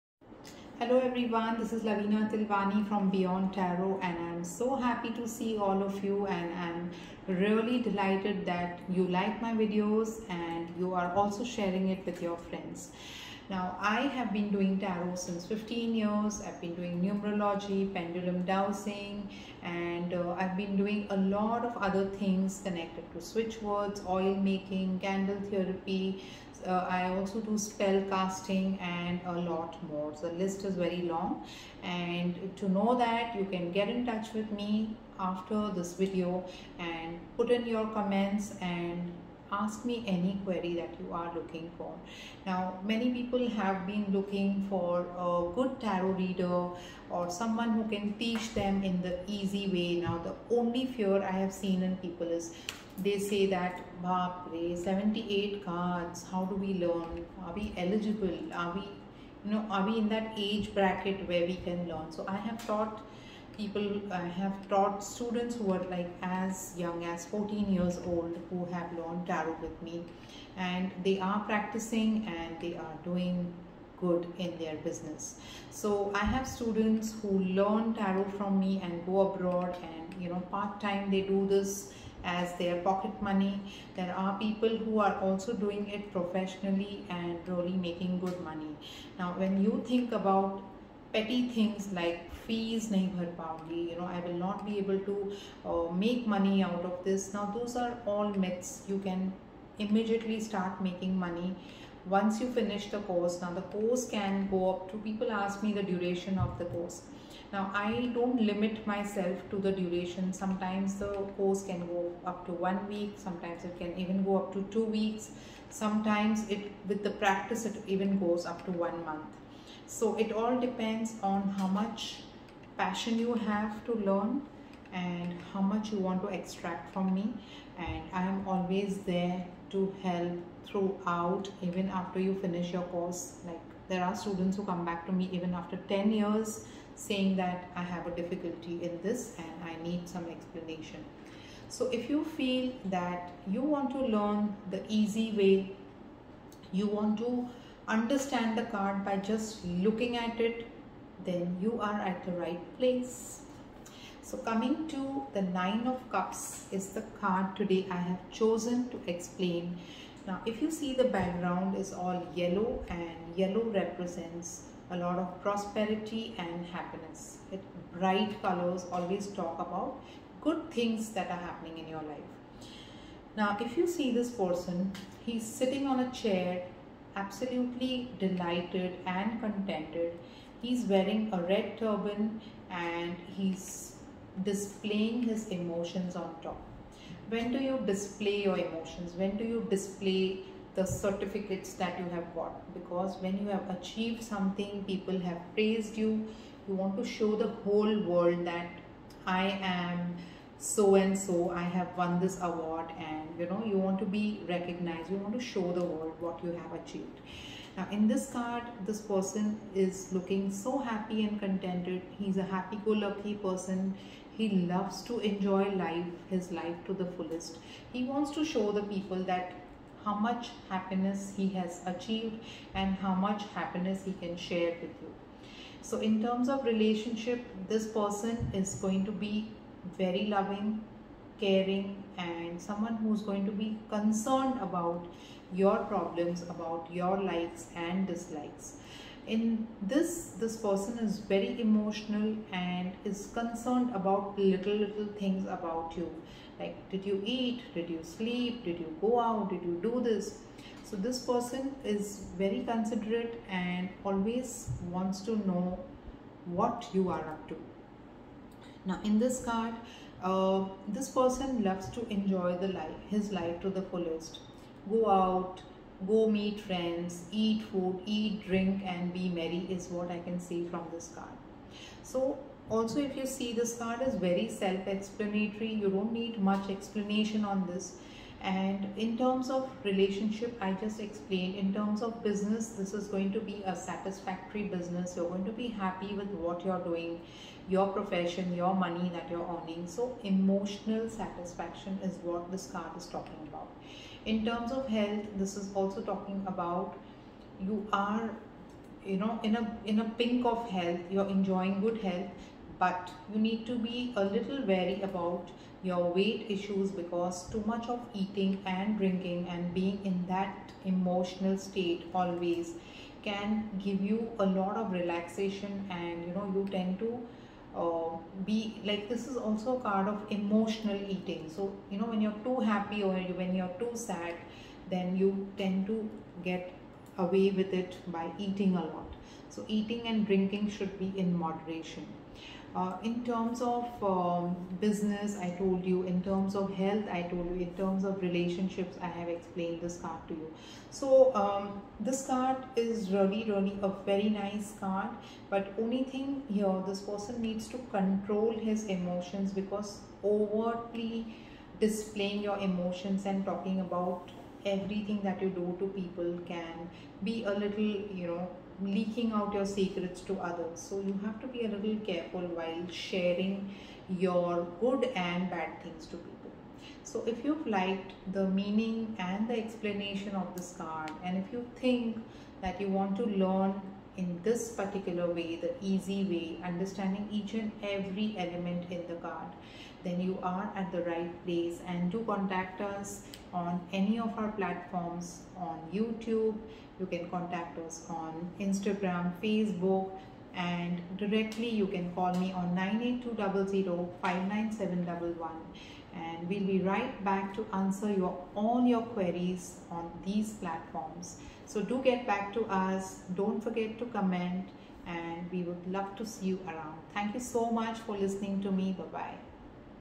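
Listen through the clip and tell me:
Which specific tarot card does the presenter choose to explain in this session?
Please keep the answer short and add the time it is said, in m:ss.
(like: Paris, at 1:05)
Nine of Cups, at 2:35.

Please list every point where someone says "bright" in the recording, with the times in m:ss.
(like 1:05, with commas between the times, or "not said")
2:47.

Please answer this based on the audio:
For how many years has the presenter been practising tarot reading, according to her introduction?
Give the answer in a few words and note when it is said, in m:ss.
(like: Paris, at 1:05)
15, at 0:15.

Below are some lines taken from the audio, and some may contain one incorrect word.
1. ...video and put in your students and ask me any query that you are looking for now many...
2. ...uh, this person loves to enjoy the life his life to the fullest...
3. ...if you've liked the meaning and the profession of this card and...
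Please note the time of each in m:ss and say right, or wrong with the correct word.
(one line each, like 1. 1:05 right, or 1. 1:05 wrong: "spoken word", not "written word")
1. 0:35 wrong: "comments", not "students"
2. 4:20 right
3. 6:07 wrong: "explanation", not "profession".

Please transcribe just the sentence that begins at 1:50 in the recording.
Sometimes the course can go up to one week, sometimes it can even go up to two weeks.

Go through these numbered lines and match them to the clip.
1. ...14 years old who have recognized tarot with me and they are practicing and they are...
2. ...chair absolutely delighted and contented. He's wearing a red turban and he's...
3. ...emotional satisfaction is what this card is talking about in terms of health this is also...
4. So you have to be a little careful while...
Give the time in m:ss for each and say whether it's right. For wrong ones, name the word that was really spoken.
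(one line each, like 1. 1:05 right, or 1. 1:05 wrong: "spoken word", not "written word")
1. 1:07 wrong: "learned", not "recognized"
2. 2:56 right
3. 4:50 right
4. 6:00 right.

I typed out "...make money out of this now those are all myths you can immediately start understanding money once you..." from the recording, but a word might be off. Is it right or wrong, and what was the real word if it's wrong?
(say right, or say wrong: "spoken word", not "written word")
wrong: "making", not "understanding".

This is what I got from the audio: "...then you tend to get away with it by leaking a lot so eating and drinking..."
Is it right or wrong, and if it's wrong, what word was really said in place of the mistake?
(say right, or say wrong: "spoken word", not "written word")
wrong: "eating", not "leaking".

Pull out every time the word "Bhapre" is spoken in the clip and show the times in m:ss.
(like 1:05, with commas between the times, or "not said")
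0:54.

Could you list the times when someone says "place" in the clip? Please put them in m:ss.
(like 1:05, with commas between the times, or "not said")
2:32, 6:21.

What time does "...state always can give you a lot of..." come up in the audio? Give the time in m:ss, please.
5:11.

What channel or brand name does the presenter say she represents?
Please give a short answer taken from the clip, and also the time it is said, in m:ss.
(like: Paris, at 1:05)
Beyond Tarot, at 0:03.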